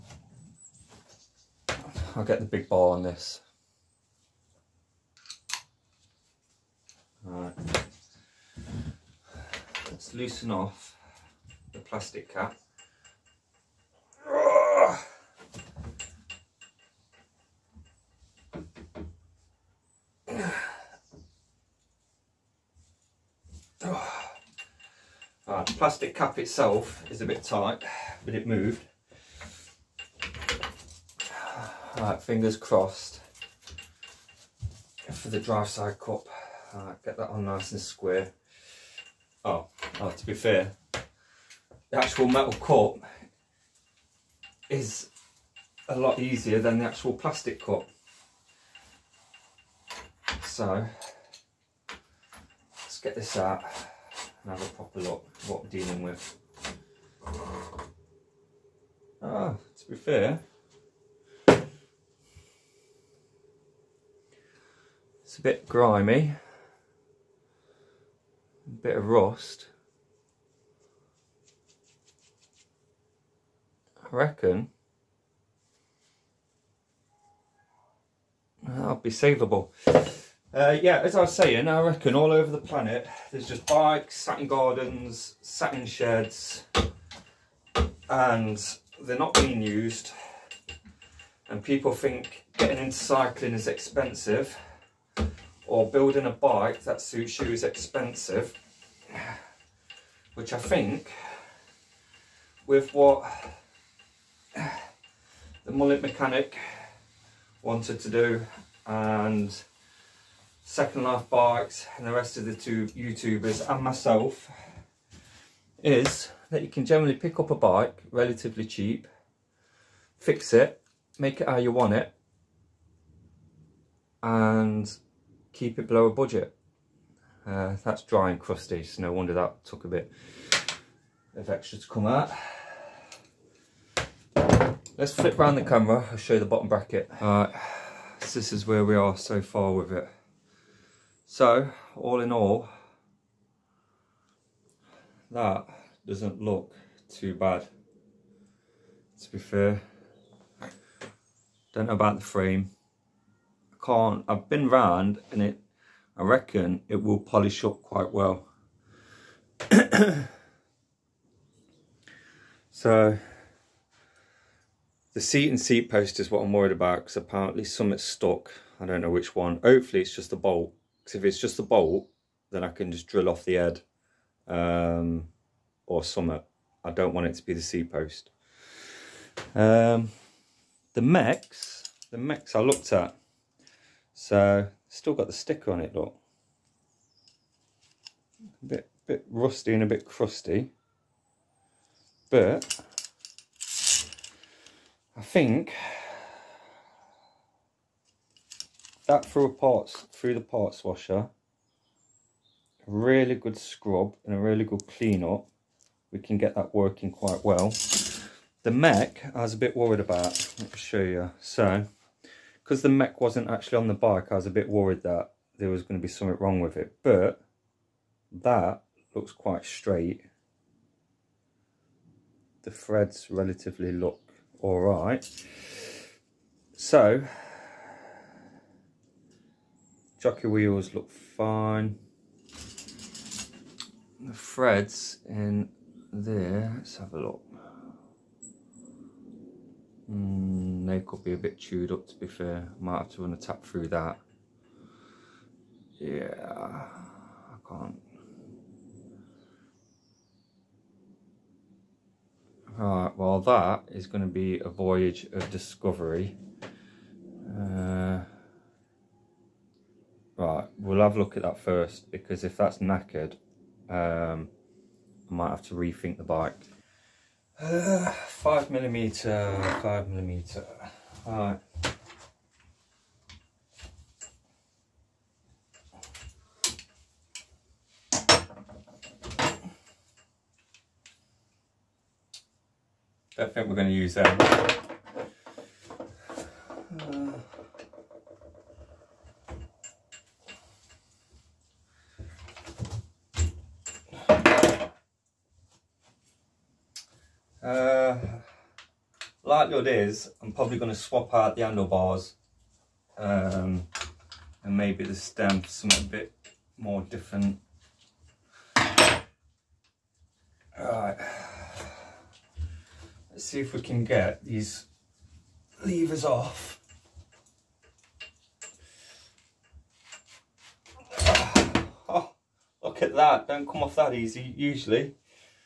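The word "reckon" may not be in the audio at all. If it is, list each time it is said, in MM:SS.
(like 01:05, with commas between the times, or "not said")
01:14, 01:21, 02:36.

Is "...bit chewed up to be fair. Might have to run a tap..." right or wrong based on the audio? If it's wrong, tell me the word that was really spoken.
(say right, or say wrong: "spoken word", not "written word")
right.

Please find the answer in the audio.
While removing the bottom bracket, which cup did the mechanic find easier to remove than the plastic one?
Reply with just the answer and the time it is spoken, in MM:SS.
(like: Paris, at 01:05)
metal cup, at 00:42.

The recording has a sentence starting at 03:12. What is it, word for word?
But I think that through a parts through the parts washer.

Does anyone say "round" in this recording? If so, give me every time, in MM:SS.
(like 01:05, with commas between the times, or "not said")
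02:15, 02:34.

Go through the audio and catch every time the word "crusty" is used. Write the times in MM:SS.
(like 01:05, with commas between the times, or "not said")
02:08, 03:10.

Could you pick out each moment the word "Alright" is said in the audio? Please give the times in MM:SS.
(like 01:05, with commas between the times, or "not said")
00:07, 02:17, 05:10.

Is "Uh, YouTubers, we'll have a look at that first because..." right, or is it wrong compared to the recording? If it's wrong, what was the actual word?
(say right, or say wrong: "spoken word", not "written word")
wrong: "Right", not "YouTubers".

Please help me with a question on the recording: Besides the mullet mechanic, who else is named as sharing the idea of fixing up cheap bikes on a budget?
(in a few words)
Second Life Bikes.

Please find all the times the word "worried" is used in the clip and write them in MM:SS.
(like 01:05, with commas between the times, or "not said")
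02:46, 03:29, 03:34.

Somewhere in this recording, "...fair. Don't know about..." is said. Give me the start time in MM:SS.
02:29.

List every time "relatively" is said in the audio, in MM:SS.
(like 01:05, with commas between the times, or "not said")
01:58, 03:43.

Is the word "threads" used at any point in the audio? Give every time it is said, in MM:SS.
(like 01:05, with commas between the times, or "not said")
03:42, 03:54.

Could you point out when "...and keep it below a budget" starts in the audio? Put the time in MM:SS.
02:04.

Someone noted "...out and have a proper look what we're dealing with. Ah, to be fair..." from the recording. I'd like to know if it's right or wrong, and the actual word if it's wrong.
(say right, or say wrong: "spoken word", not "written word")
right.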